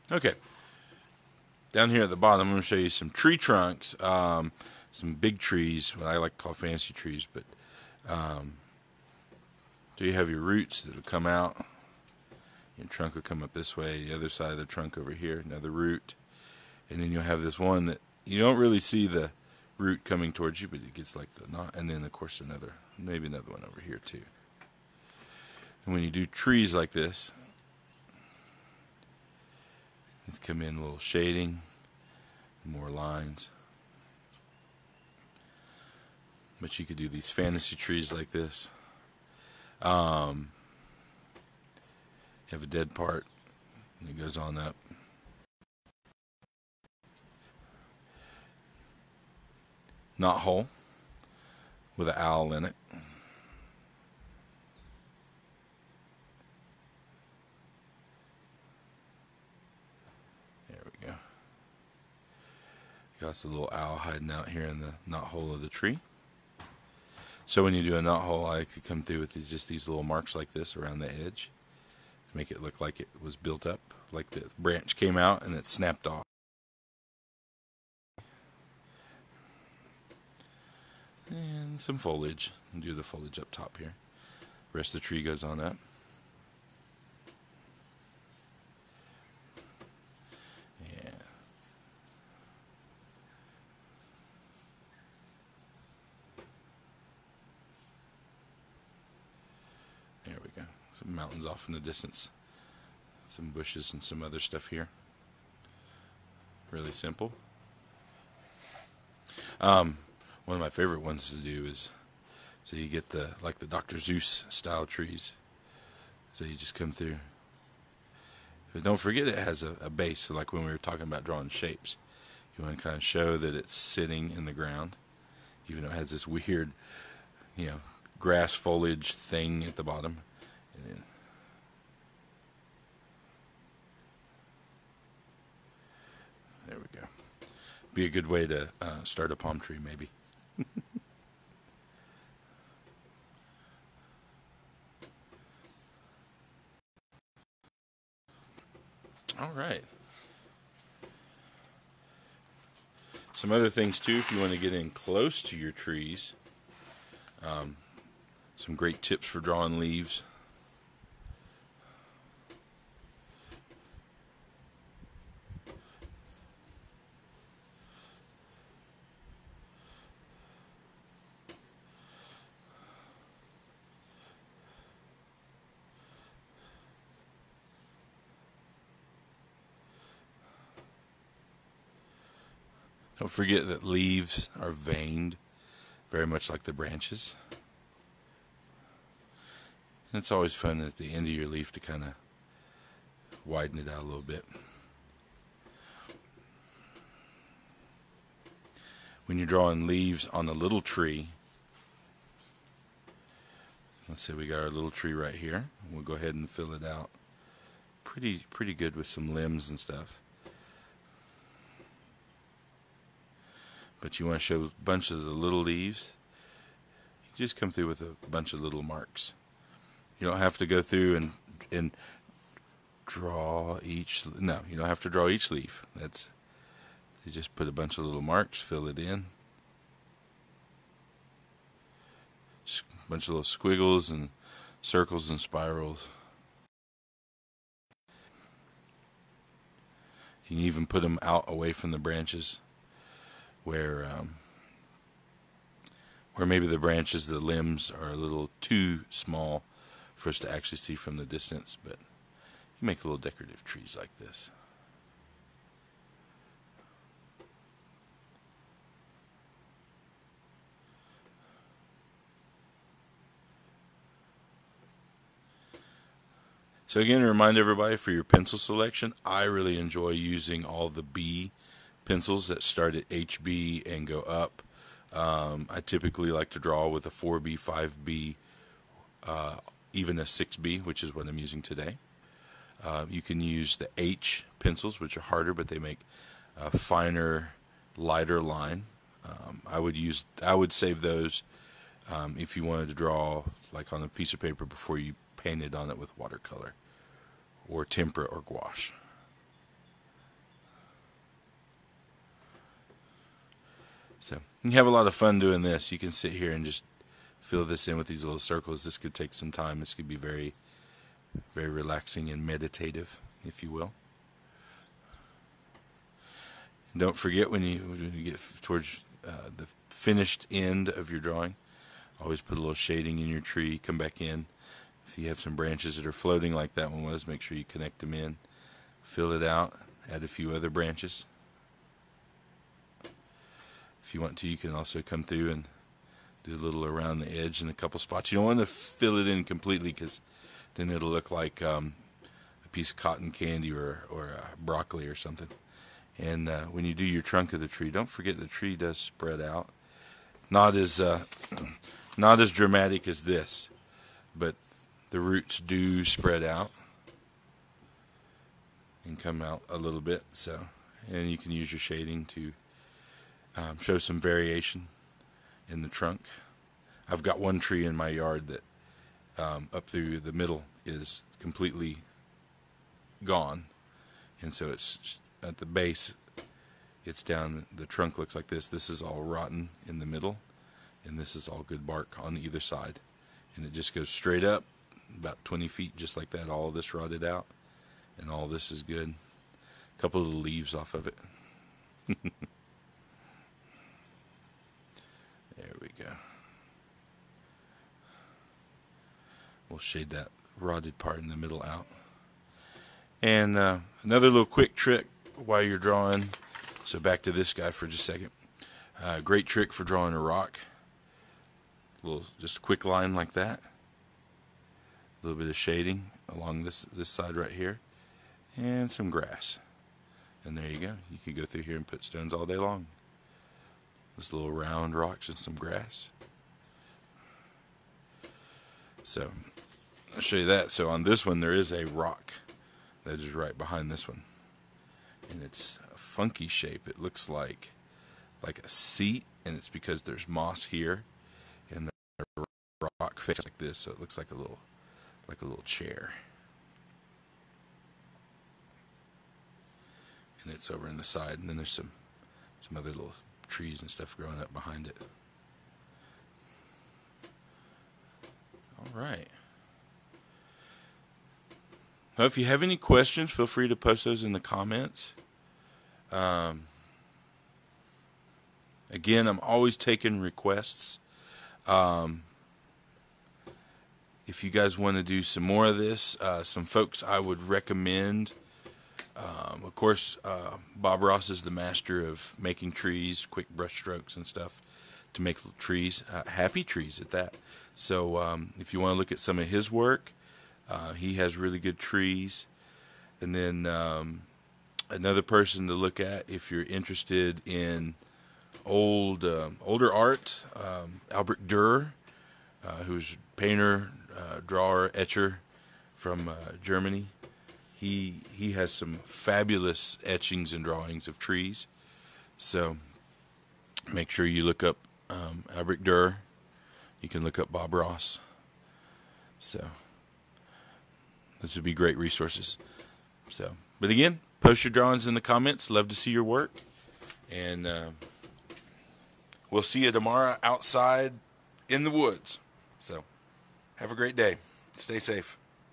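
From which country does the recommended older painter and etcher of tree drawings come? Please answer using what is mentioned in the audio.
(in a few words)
Germany.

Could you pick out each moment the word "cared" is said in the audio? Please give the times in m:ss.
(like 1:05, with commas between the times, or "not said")
not said.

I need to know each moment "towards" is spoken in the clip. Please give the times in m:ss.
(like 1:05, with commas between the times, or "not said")
0:20, 5:18.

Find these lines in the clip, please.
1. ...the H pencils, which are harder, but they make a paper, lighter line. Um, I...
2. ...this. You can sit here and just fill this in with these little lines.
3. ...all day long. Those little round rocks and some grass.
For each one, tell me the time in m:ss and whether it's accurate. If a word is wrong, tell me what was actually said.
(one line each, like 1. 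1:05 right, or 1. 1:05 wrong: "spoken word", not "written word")
1. 4:43 wrong: "finer", not "paper"
2. 5:05 wrong: "circles", not "lines"
3. 7:02 right.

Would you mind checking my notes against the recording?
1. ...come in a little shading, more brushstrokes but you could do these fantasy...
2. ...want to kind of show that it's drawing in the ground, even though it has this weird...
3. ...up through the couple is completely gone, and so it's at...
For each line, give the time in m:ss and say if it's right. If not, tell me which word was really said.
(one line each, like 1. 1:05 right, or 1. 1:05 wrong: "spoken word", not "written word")
1. 0:30 wrong: "lines", not "brushstrokes"
2. 2:02 wrong: "sitting", not "drawing"
3. 6:09 wrong: "middle", not "couple".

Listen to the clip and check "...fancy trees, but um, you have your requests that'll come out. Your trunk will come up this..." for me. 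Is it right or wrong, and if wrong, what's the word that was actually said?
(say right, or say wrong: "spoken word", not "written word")
wrong: "roots", not "requests".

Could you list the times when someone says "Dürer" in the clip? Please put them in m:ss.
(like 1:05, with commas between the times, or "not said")
8:21, 8:35.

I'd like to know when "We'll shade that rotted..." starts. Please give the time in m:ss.
6:39.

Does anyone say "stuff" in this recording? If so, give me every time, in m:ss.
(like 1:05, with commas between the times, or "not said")
1:44, 3:29, 7:33, 8:04.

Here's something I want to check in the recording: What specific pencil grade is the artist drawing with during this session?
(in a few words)
6B.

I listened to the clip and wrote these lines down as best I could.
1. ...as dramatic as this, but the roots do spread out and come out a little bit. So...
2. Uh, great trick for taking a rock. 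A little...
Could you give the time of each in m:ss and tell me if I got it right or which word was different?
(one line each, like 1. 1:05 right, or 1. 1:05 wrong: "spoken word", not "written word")
1. 5:52 right
2. 6:49 wrong: "drawing", not "taking".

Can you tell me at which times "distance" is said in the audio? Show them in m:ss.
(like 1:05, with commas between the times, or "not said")
1:41, 4:11.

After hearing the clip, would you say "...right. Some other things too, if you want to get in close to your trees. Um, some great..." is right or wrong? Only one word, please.
right.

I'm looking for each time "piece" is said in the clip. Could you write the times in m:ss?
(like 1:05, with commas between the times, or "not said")
4:54, 5:42.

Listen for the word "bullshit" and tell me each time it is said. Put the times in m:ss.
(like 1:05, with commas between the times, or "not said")
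not said.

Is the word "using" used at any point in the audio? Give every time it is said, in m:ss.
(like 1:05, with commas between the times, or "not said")
4:30, 4:41.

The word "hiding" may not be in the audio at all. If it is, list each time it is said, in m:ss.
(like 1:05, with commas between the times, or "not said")
1:03.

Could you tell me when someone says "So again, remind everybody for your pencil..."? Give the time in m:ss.
4:26.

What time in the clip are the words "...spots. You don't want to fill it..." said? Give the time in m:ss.
5:37.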